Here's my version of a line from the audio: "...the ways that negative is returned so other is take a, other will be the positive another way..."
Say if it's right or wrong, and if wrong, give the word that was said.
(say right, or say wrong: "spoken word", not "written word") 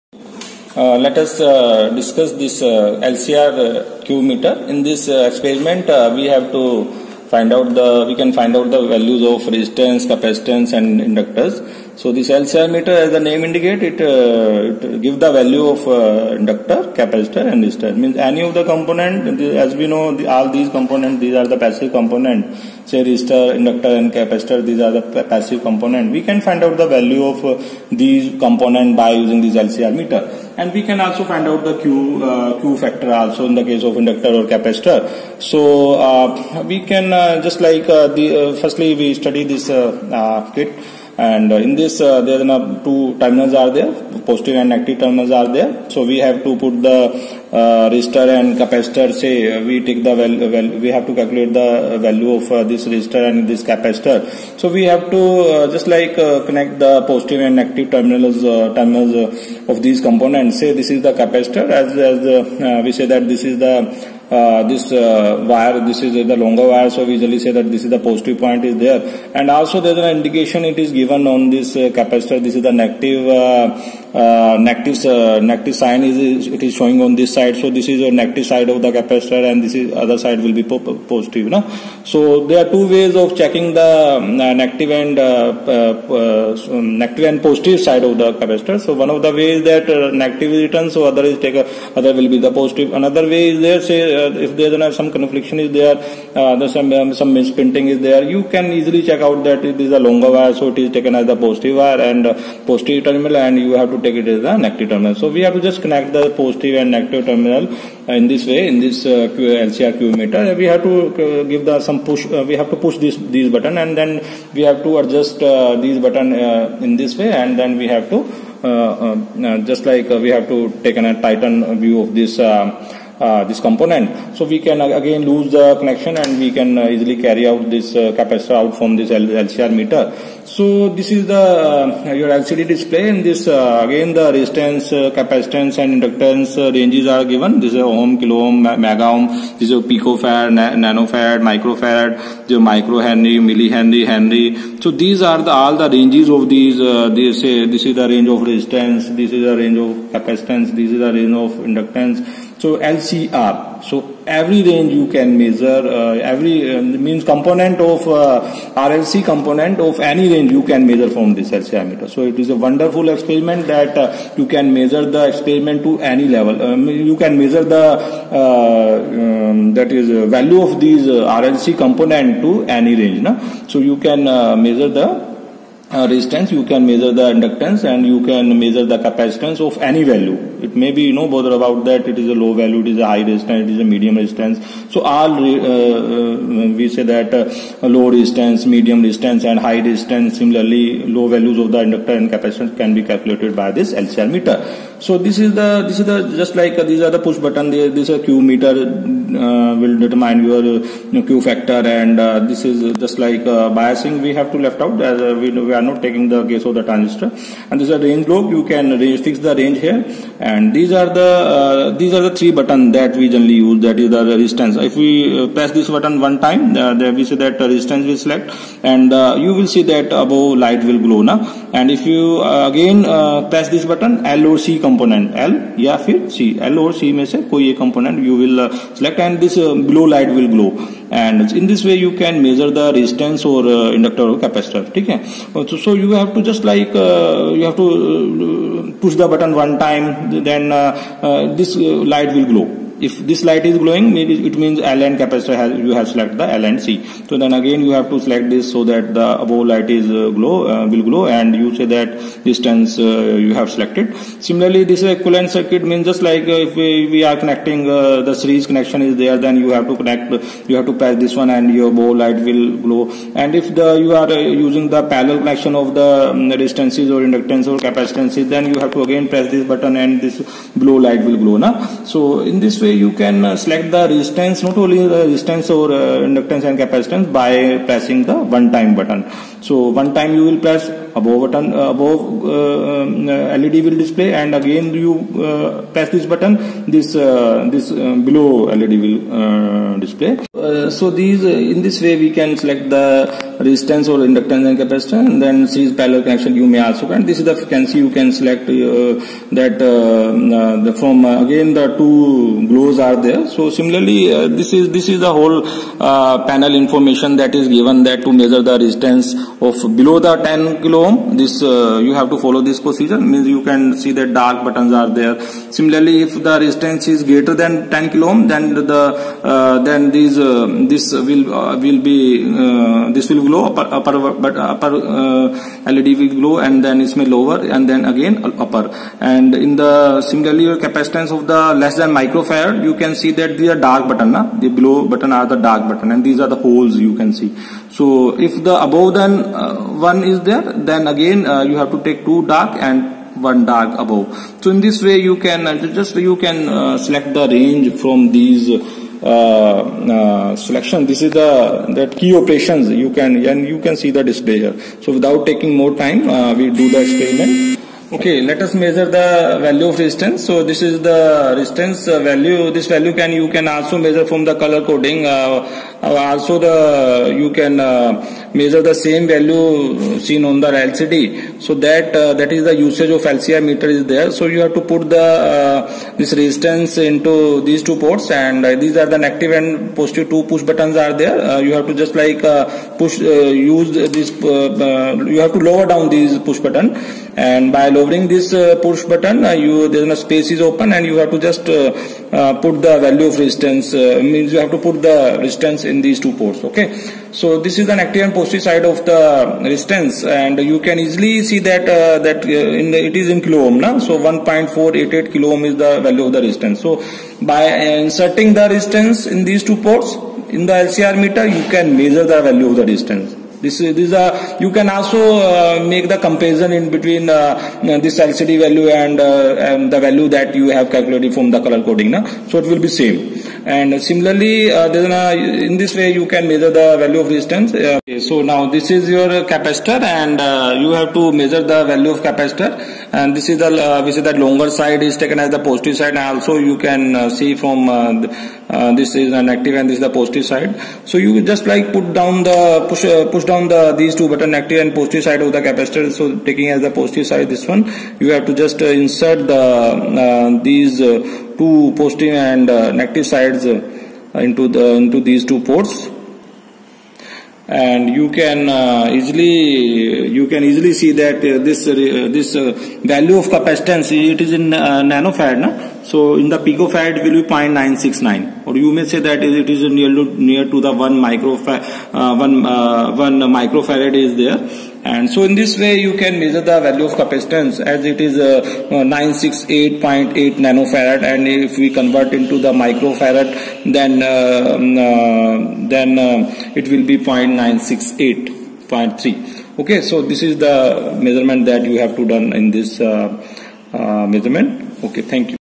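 right.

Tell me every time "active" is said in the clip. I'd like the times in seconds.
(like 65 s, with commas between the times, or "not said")
397 s, 439 s, 444 s.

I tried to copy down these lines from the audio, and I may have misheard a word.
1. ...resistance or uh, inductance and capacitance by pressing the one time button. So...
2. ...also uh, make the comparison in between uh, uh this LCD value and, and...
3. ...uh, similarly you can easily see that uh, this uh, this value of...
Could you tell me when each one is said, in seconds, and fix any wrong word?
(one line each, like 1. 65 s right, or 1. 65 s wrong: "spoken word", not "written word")
1. 275 s right
2. 414 s right
3. 458 s wrong: "easily", not "similarly".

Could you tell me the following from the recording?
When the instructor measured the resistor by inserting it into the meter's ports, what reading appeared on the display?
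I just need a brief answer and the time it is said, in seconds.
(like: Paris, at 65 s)
1.488 kilo ohm, at 404 s.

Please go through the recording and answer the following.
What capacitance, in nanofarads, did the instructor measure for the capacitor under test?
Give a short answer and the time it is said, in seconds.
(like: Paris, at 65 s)
968.8 nanofarad, at 478 s.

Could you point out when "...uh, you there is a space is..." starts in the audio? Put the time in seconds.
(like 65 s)
389 s.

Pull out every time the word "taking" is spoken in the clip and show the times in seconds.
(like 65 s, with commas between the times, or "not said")
206 s, 355 s, 446 s.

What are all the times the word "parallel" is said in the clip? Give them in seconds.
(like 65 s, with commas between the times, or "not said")
265 s, 296 s.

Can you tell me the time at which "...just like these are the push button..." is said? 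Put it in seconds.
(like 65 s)
196 s.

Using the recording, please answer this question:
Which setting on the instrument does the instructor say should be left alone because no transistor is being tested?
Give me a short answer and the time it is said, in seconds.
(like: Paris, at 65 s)
biasing, at 203 s.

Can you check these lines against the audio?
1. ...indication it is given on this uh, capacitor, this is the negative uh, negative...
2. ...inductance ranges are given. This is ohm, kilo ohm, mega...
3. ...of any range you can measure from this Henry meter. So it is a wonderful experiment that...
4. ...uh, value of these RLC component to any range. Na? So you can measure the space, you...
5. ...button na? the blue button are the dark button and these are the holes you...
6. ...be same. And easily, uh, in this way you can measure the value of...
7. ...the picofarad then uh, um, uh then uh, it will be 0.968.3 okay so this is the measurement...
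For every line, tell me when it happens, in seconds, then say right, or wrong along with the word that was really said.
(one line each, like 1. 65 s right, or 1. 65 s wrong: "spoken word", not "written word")
1. 70 s right
2. 136 s right
3. 159 s wrong: "LCR", not "Henry"
4. 170 s wrong: "resistance", not "space"
5. 334 s right
6. 422 s wrong: "similarly", not "easily"
7. 482 s wrong: "microfarad", not "picofarad".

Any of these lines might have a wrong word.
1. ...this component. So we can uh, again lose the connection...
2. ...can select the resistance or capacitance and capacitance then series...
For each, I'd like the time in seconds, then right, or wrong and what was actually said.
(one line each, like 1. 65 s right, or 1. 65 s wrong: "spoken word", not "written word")
1. 123 s right
2. 292 s wrong: "inductance", not "capacitance".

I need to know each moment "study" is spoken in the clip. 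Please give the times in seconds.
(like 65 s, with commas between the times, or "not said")
39 s.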